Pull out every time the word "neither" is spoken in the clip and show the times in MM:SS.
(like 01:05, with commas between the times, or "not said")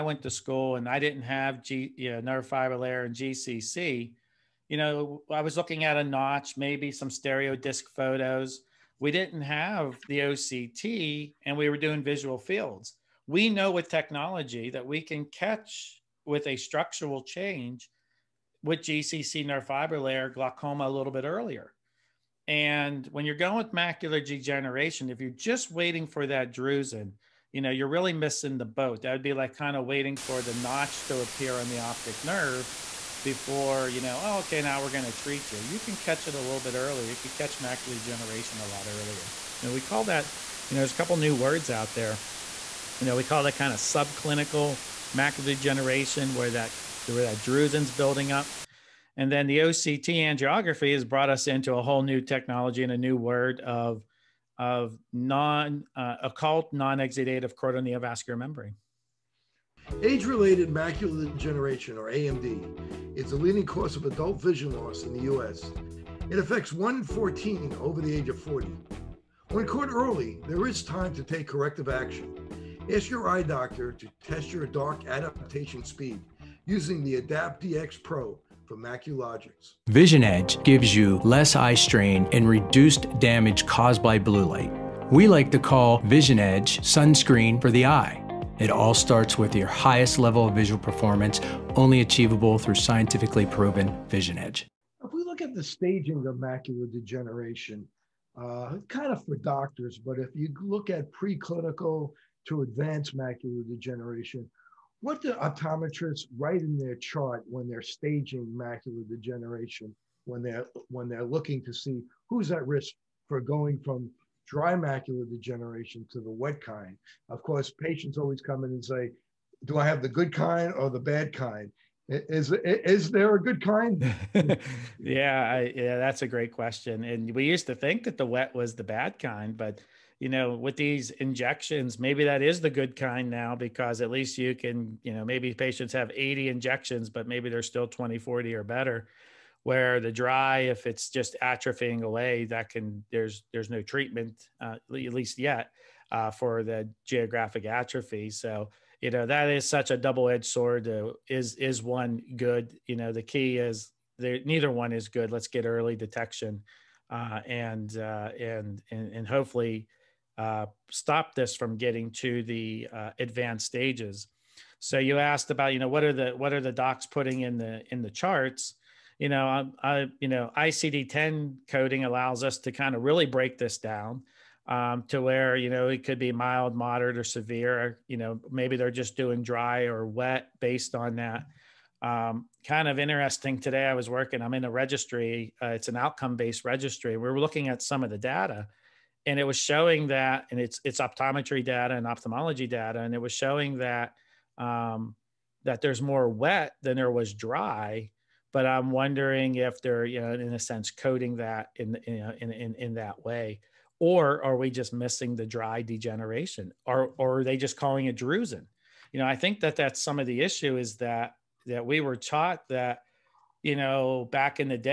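02:34.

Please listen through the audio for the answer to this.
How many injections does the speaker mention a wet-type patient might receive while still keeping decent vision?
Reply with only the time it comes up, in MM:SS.
02:16.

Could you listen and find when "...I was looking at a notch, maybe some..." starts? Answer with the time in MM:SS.
00:05.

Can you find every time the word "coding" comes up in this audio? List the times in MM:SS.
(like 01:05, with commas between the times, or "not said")
02:51, 03:20.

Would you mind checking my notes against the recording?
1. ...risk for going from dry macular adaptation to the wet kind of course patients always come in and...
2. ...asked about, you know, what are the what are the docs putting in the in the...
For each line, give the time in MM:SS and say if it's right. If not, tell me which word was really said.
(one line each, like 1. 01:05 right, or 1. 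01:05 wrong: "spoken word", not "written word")
1. 01:52 wrong: "degeneration", not "adaptation"
2. 02:45 right.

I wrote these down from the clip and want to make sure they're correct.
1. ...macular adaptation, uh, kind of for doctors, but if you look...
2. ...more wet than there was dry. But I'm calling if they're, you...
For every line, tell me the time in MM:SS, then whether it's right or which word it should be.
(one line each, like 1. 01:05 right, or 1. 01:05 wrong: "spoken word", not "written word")
1. 01:36 wrong: "degeneration", not "adaptation"
2. 03:16 wrong: "wondering", not "calling".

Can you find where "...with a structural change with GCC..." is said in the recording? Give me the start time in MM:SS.
00:16.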